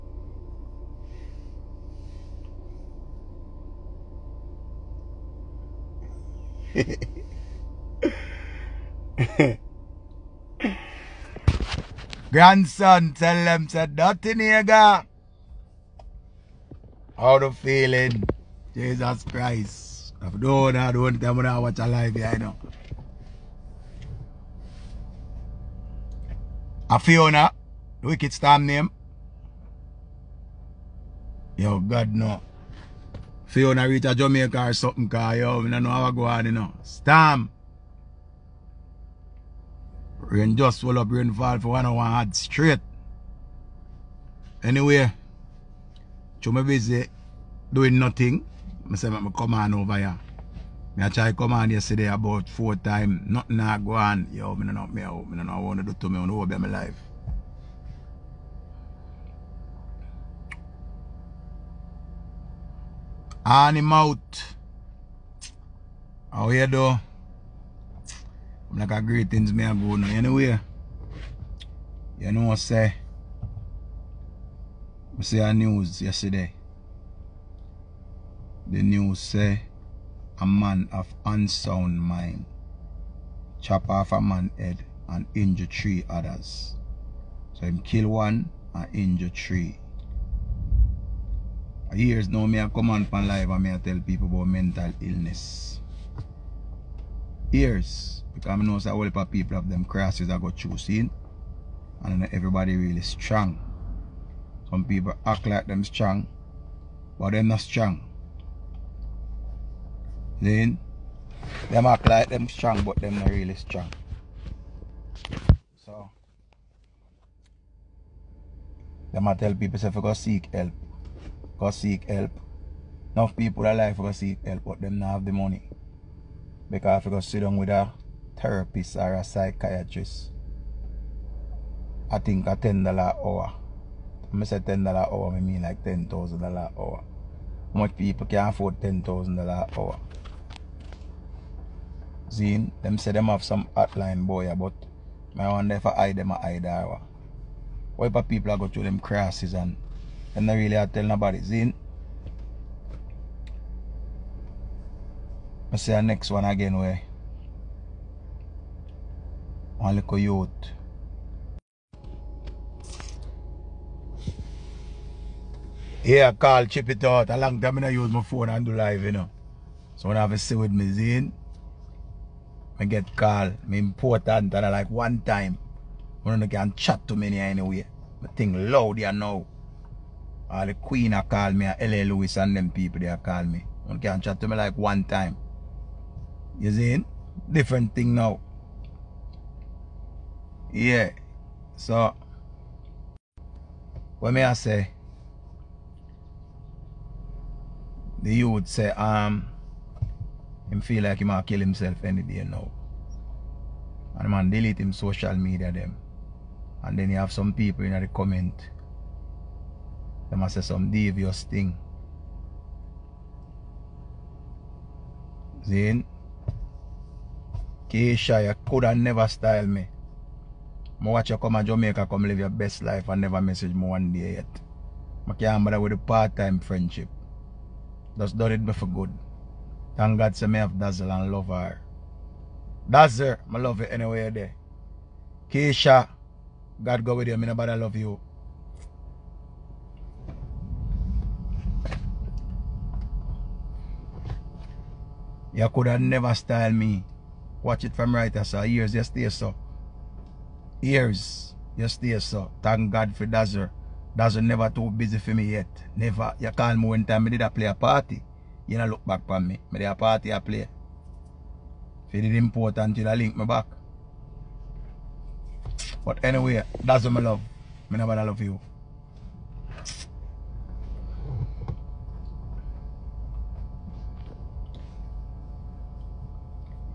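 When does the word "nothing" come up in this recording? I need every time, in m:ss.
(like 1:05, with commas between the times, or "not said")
0:13, 0:47, 0:53.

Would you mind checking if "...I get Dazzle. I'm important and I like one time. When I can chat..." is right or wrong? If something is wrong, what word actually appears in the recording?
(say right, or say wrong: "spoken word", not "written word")
wrong: "Carl", not "Dazzle".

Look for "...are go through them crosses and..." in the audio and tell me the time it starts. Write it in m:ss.
2:28.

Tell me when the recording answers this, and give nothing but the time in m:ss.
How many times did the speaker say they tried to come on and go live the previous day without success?
0:52.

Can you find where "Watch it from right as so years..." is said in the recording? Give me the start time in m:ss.
4:07.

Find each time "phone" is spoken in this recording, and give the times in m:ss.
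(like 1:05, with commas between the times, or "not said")
2:48.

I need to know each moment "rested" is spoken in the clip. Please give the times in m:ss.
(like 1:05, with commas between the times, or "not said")
not said.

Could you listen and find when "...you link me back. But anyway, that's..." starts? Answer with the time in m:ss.
4:22.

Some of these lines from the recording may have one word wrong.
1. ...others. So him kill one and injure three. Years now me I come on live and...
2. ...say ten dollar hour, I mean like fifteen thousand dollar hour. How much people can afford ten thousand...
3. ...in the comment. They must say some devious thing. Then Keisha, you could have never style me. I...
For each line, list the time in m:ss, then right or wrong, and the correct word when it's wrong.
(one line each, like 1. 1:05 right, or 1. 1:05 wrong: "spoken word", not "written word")
1. 1:26 right
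2. 2:14 wrong: "ten", not "fifteen"
3. 3:27 right.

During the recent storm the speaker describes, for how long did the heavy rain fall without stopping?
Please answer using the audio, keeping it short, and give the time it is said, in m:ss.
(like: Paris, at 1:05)
one hour, at 0:41.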